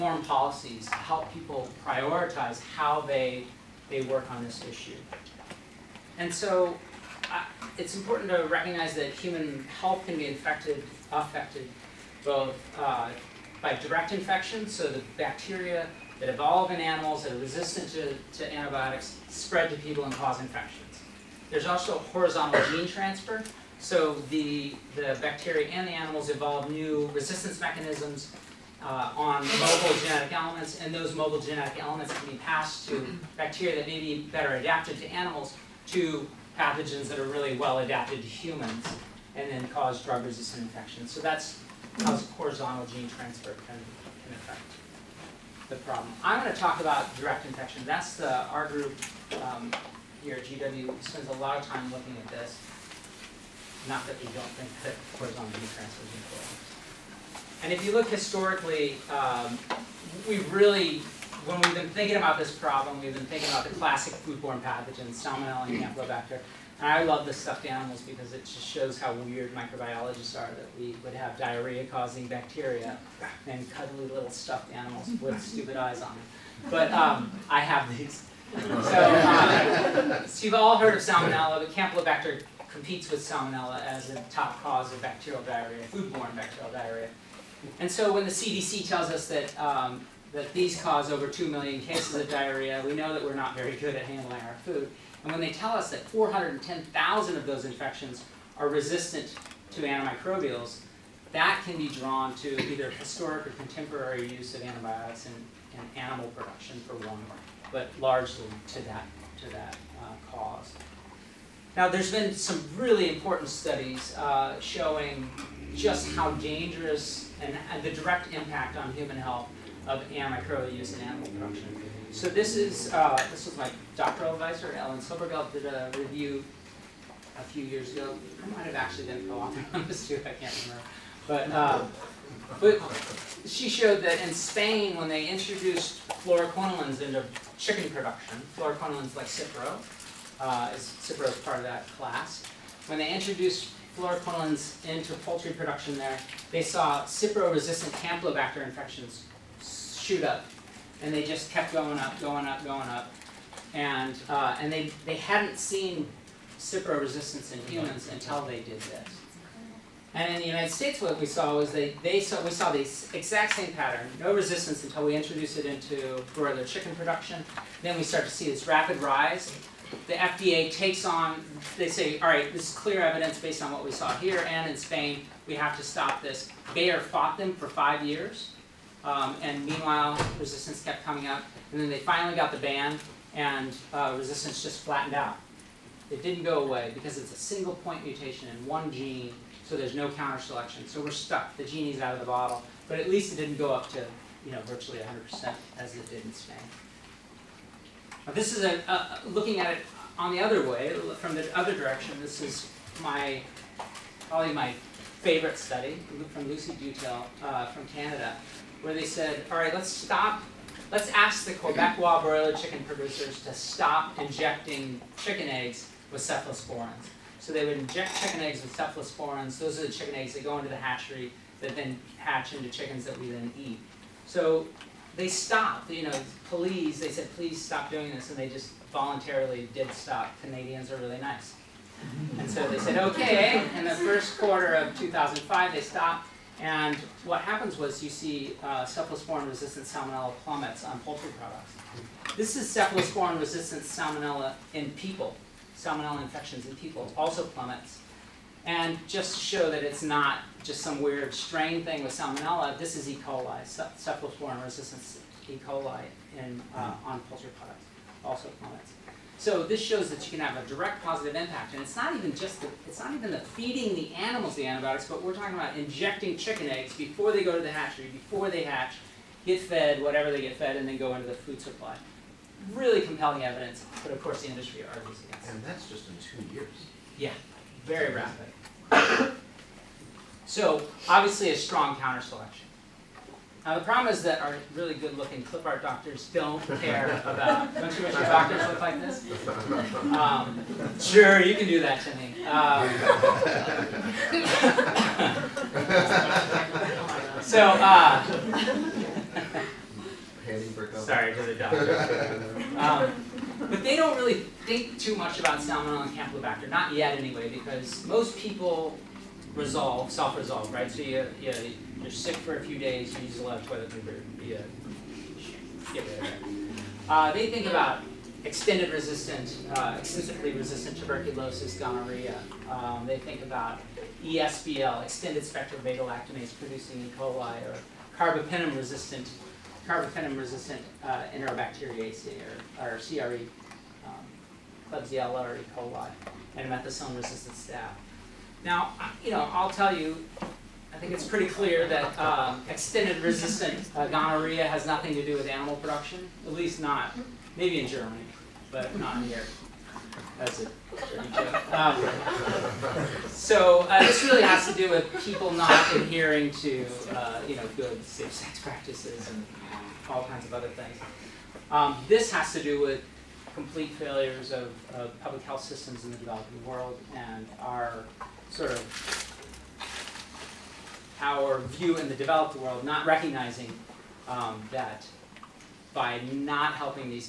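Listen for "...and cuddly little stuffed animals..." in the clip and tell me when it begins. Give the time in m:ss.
1:13.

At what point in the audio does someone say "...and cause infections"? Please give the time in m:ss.
0:20.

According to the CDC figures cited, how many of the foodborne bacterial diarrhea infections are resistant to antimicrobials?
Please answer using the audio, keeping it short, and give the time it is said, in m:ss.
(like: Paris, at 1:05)
410,000, at 1:36.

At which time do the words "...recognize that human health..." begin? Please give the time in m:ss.
0:08.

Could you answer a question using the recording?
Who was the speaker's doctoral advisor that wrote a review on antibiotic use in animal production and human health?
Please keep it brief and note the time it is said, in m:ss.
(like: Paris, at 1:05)
Ellen Silbergeld, at 2:04.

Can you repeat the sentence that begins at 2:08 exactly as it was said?
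I might have actually been co-author on this too.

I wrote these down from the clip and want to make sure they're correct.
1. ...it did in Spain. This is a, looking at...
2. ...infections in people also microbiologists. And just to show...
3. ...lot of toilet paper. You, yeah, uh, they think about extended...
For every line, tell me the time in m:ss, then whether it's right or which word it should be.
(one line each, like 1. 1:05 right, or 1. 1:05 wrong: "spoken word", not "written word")
1. 3:15 right
2. 4:06 wrong: "plummets", not "microbiologists"
3. 5:13 right.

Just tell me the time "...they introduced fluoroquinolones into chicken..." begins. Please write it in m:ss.
2:15.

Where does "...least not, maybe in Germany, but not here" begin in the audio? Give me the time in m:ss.
5:46.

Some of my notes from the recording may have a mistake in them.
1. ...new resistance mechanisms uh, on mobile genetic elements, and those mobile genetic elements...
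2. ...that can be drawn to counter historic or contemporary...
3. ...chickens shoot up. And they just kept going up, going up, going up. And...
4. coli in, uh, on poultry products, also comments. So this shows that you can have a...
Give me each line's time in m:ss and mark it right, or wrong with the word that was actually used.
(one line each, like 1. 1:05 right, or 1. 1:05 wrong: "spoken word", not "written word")
1. 0:26 right
2. 1:41 wrong: "either", not "counter"
3. 2:28 wrong: "infections", not "chickens"
4. 4:15 right.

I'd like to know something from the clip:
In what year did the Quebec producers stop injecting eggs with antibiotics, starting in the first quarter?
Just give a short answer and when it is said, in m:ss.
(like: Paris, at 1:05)
2005, at 3:54.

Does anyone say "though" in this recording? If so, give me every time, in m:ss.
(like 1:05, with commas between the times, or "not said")
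not said.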